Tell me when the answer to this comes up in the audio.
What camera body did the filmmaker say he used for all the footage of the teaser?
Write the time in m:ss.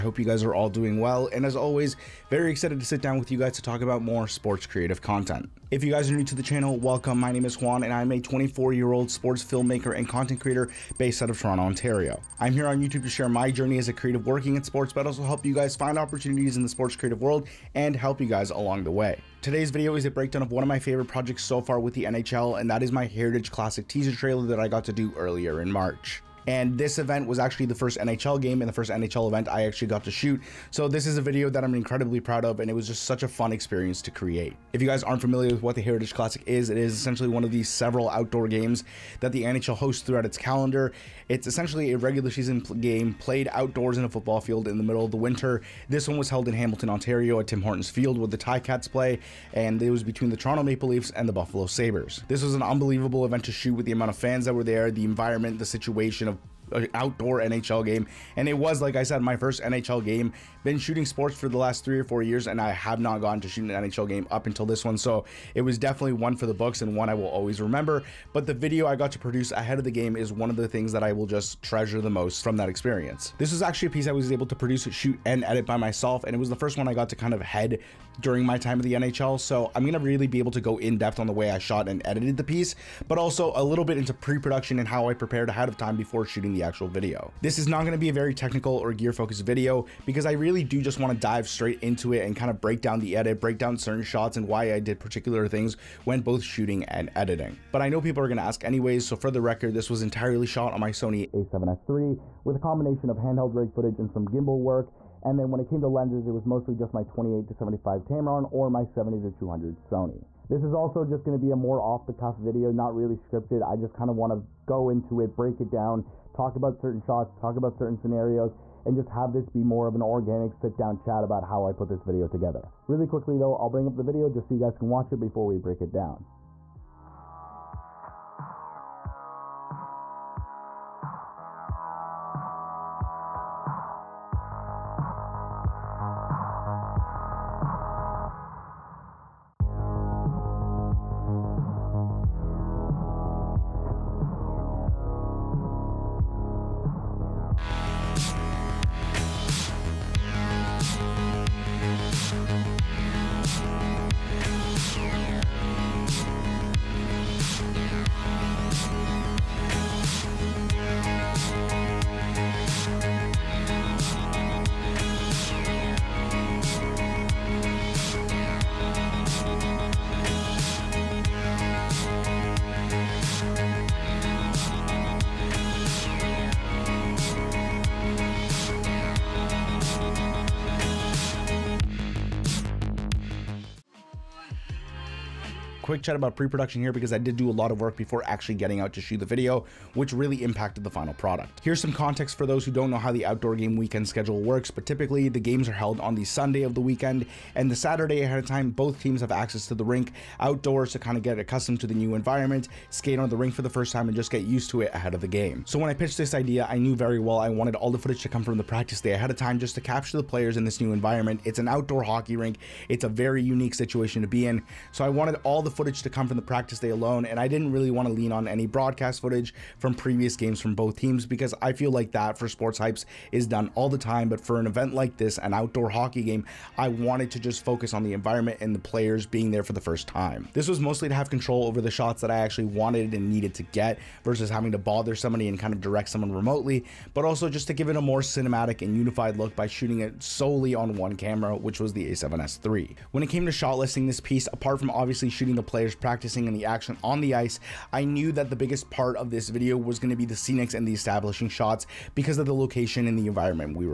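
1:40.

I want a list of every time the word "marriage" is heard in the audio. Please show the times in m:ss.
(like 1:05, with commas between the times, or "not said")
not said.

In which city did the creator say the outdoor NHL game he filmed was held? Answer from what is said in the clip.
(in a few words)
Hamilton.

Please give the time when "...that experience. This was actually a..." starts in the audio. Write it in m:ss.
1:12.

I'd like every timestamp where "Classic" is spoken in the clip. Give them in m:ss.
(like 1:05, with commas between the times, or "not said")
0:23, 0:36.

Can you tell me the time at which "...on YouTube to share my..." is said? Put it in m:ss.
0:12.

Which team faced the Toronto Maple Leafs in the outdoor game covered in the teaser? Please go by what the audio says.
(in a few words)
Buffalo Sabres.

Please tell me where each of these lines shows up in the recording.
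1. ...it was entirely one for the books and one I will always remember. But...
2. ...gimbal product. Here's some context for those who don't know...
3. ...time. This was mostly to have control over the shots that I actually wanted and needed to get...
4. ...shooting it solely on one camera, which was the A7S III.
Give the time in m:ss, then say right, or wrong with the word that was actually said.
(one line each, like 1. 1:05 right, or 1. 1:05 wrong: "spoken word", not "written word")
1. 1:05 wrong: "definitely", not "entirely"
2. 3:10 wrong: "final", not "gimbal"
3. 3:50 right
4. 3:59 right.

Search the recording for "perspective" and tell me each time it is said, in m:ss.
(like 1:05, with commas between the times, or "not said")
not said.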